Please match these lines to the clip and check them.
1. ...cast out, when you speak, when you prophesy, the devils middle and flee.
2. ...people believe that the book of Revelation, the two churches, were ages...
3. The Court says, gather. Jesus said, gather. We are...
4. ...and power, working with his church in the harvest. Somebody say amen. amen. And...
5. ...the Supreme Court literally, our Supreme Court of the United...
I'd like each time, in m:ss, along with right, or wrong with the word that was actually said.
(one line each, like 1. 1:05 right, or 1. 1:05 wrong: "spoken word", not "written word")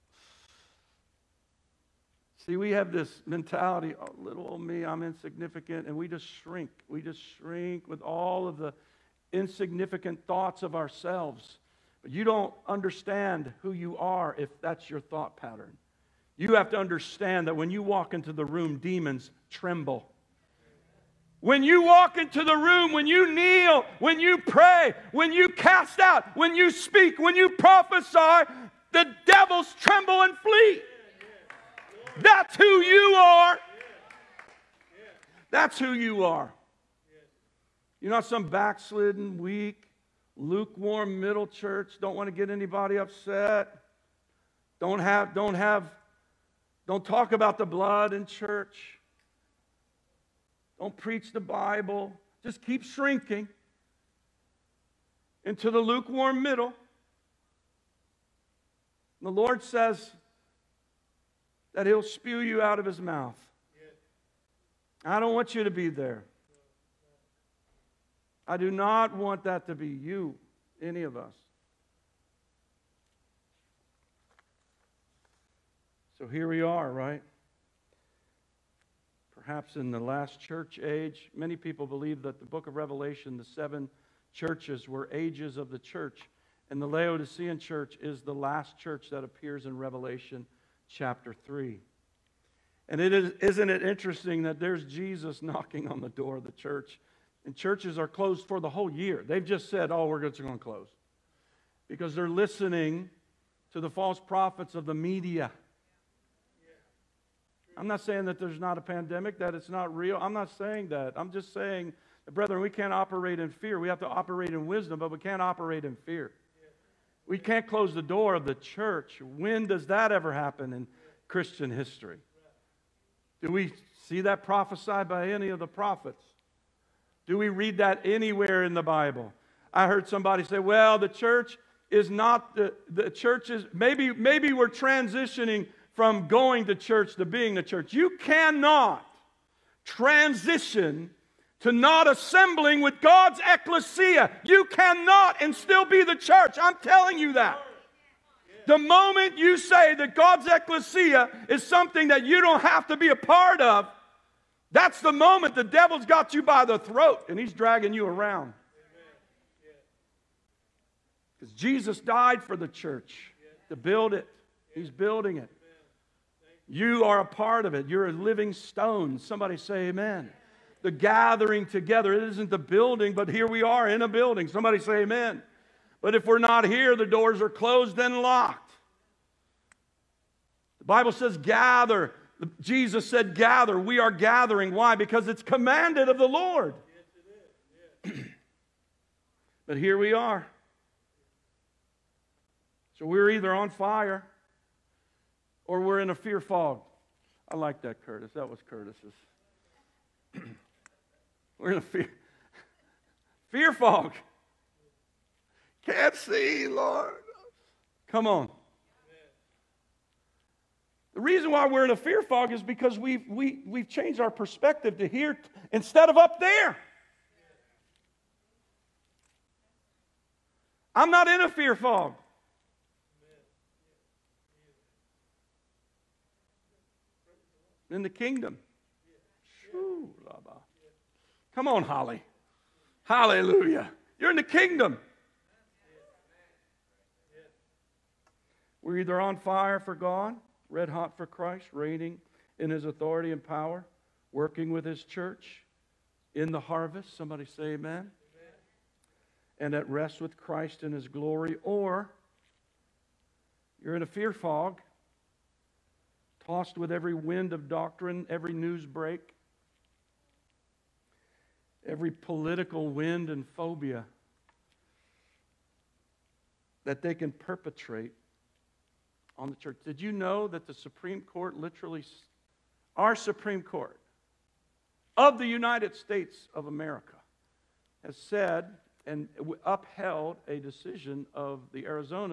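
1. 0:25 wrong: "tremble", not "middle"
2. 1:21 wrong: "seven", not "two"
3. 3:00 wrong: "Bible", not "Court"
4. 4:03 right
5. 4:30 right.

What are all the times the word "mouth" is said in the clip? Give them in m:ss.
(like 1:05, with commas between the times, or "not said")
1:02.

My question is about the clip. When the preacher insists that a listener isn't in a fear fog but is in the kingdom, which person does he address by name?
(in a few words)
Holly.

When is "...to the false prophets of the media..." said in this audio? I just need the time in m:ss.
1:43.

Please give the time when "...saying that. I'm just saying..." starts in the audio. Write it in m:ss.
1:50.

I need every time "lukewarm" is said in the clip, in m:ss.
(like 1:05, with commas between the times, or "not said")
0:40, 0:55.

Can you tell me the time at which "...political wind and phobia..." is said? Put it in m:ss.
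4:22.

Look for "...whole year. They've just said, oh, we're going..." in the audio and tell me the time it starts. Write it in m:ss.
1:38.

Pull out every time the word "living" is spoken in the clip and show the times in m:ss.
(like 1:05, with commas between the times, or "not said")
2:48.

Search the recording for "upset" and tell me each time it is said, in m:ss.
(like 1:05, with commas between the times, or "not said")
0:42.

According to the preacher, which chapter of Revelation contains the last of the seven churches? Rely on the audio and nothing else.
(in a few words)
chapter 3.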